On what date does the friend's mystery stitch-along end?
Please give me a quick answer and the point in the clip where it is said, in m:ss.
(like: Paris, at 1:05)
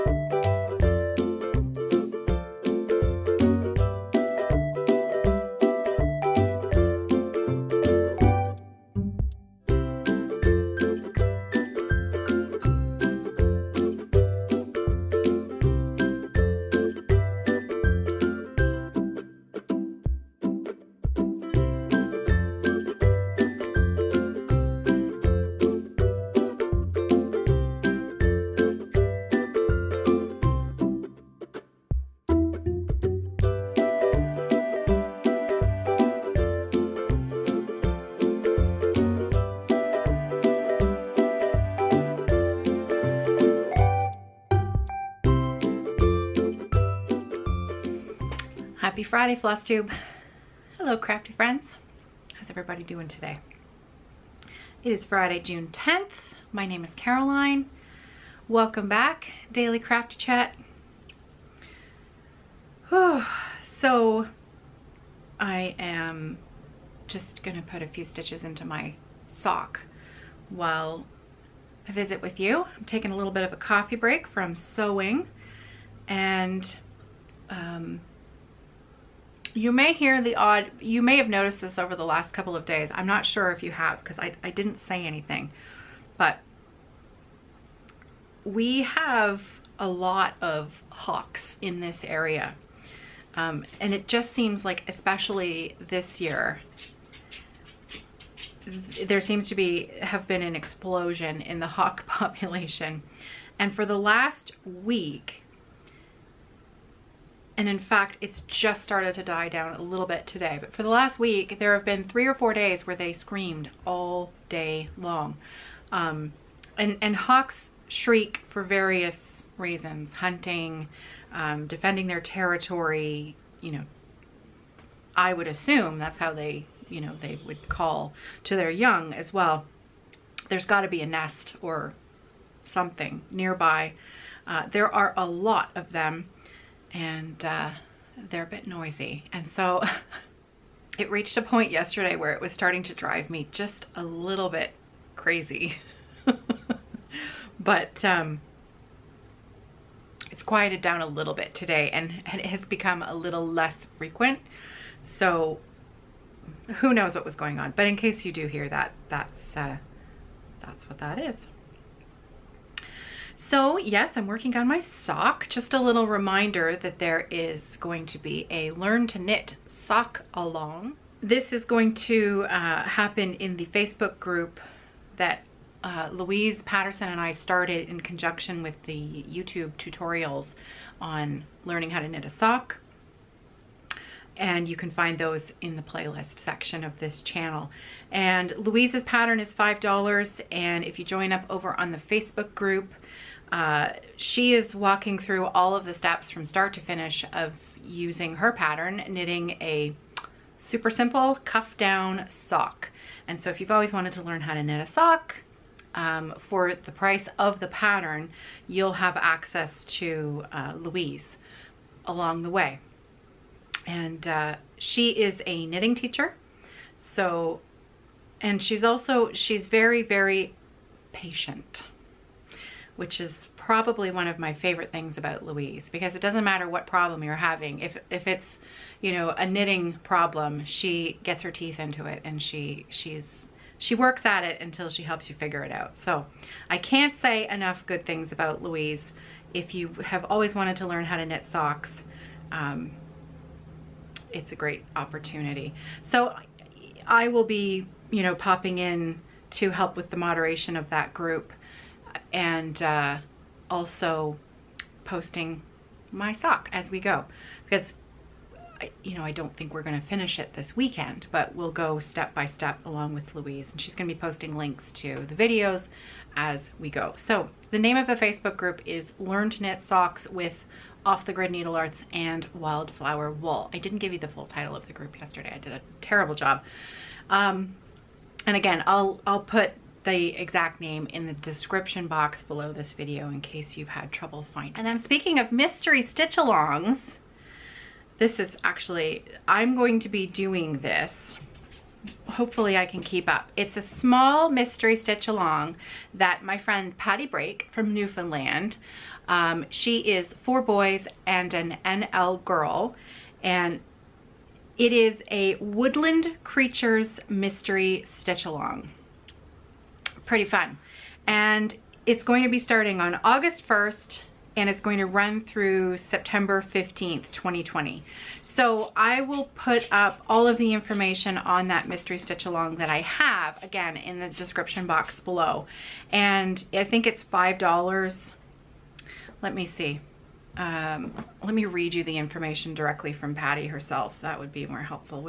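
September 15th, at 5:15.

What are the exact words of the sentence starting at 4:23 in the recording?
And she's going to be posting links to the videos as we go.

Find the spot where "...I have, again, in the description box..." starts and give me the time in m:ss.
5:22.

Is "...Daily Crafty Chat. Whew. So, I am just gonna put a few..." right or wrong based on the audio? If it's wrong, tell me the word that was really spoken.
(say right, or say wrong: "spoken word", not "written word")
right.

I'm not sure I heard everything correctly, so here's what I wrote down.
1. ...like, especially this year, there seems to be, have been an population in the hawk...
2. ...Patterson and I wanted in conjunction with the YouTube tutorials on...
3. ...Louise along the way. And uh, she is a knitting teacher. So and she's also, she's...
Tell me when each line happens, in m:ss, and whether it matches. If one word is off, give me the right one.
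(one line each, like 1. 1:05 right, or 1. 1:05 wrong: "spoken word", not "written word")
1. 1:34 wrong: "explosion", not "population"
2. 2:56 wrong: "started", not "wanted"
3. 3:30 right.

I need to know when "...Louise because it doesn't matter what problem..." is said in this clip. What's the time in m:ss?
3:45.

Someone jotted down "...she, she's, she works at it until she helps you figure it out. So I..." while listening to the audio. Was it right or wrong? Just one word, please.
right.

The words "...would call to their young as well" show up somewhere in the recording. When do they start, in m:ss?
2:07.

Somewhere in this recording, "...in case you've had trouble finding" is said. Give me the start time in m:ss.
4:43.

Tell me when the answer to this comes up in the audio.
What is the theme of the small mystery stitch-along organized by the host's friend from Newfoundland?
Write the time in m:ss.
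5:05.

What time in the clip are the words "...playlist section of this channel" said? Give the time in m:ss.
3:05.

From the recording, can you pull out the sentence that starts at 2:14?
Uh, there are a lot of them and uh, they're a bit noisy.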